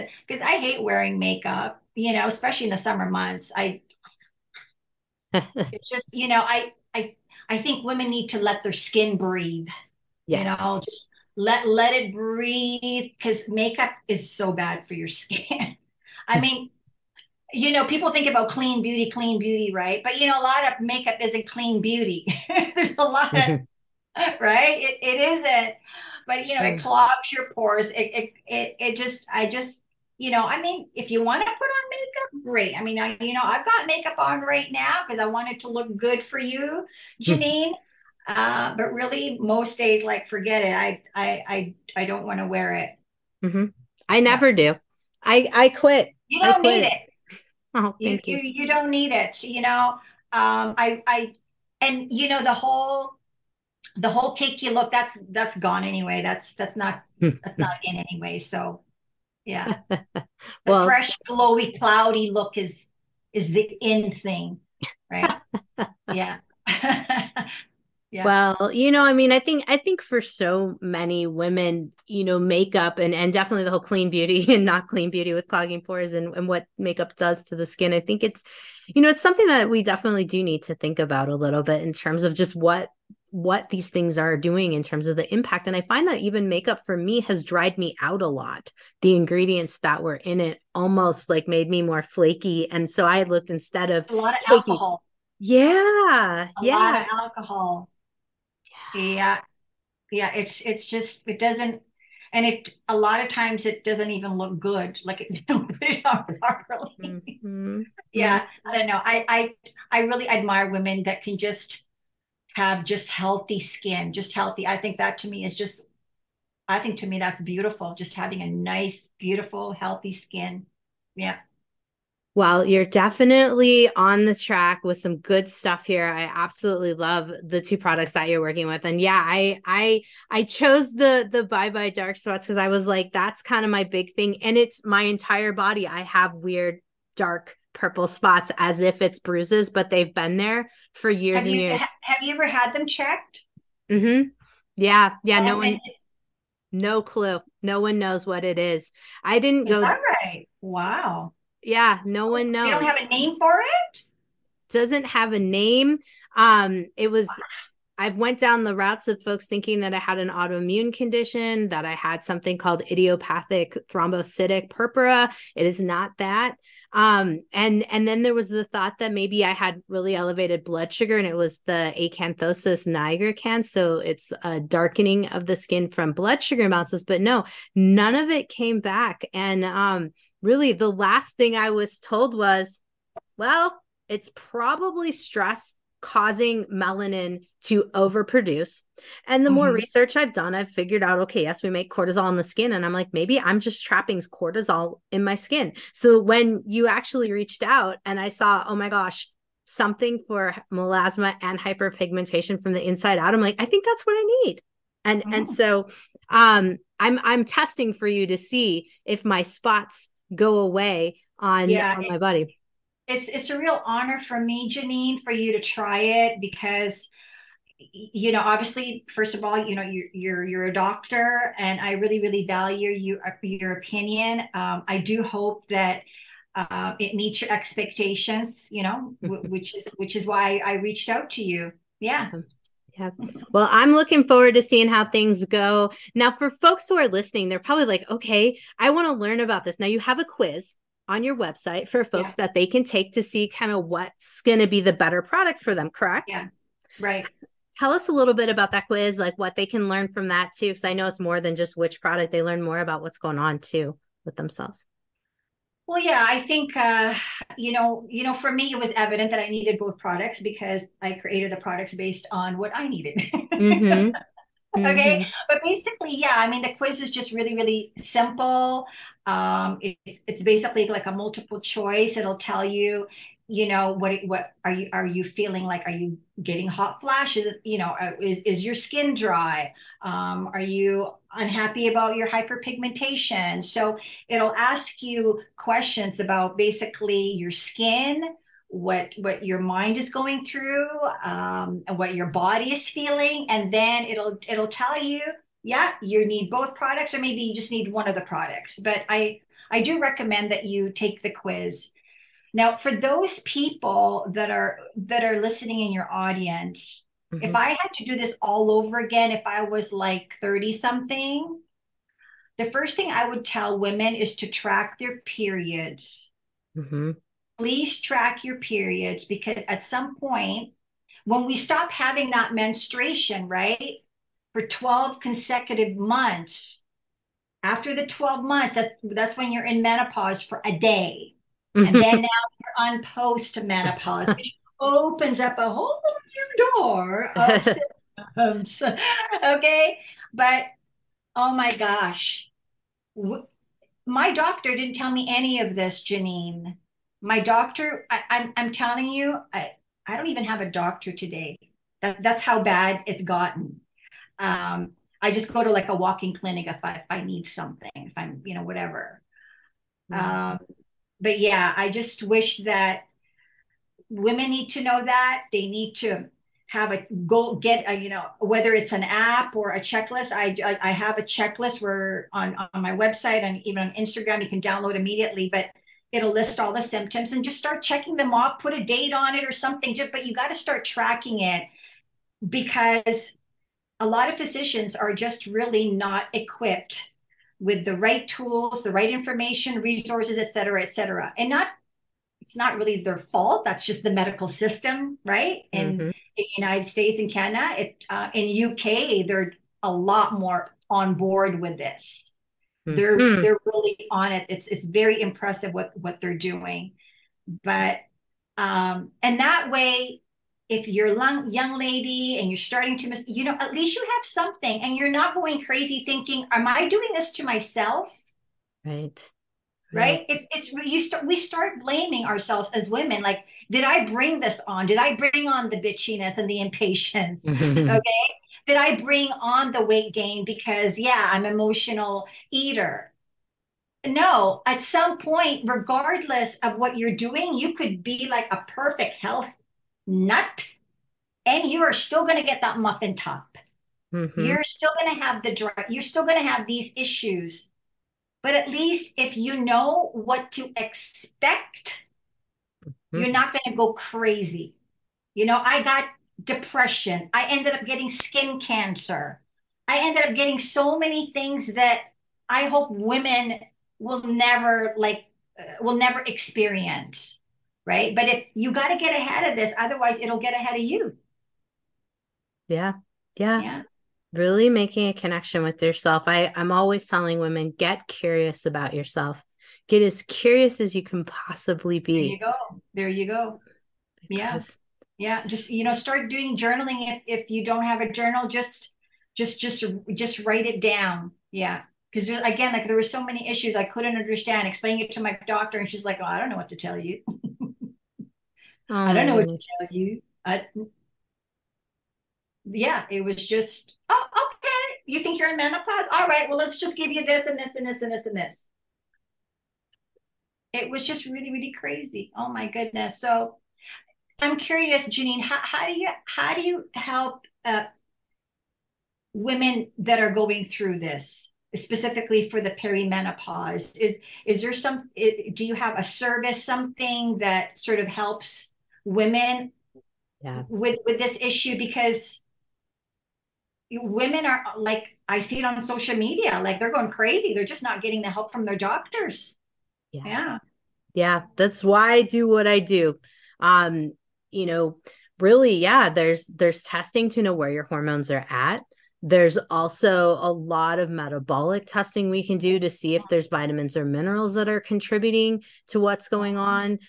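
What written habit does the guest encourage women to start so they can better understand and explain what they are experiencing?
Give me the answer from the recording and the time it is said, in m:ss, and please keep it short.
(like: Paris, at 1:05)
Journaling, at 8:06.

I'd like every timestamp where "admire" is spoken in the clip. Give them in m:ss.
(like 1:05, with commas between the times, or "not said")
1:50.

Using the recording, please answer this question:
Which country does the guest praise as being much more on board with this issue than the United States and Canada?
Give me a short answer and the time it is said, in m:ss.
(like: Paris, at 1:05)
UK, at 6:38.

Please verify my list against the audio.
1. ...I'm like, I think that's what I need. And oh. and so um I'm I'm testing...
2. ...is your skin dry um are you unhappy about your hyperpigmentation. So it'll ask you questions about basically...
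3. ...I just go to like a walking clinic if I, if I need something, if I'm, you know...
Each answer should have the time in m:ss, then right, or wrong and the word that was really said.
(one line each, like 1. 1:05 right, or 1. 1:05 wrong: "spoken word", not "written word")
1. 3:23 right
2. 4:38 right
3. 5:55 right.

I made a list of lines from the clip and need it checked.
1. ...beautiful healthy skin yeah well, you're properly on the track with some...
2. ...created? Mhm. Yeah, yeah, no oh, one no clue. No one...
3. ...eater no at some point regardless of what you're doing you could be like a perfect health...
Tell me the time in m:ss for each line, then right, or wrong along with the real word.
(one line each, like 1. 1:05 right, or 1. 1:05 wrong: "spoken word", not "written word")
1. 1:59 wrong: "definitely", not "properly"
2. 2:22 wrong: "checked", not "created"
3. 7:12 right.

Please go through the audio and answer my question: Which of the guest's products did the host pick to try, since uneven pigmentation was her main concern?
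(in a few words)
Bye Bye Dark Spots.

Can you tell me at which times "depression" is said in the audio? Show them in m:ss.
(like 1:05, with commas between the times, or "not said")
7:36.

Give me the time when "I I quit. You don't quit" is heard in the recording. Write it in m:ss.
0:45.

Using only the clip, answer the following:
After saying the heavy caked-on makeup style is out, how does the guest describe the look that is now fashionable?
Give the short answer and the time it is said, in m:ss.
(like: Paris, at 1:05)
Fresh glowy cloudy, at 1:00.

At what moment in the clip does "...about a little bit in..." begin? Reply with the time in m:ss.
1:20.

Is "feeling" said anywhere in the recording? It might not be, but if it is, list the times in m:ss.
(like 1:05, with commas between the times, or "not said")
4:35, 4:52.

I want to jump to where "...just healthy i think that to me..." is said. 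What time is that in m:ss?
1:54.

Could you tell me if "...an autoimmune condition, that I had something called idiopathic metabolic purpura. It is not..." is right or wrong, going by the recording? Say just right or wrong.
wrong.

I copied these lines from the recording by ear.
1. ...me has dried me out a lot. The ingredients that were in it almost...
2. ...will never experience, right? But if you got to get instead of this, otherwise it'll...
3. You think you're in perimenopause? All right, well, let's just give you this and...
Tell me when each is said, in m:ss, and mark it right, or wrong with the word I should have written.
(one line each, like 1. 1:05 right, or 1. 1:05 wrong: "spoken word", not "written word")
1. 1:26 right
2. 7:45 wrong: "ahead", not "instead"
3. 8:25 wrong: "menopause", not "perimenopause".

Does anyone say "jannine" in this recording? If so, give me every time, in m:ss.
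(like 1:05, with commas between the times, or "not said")
0:37, 3:34, 5:46, 8:35.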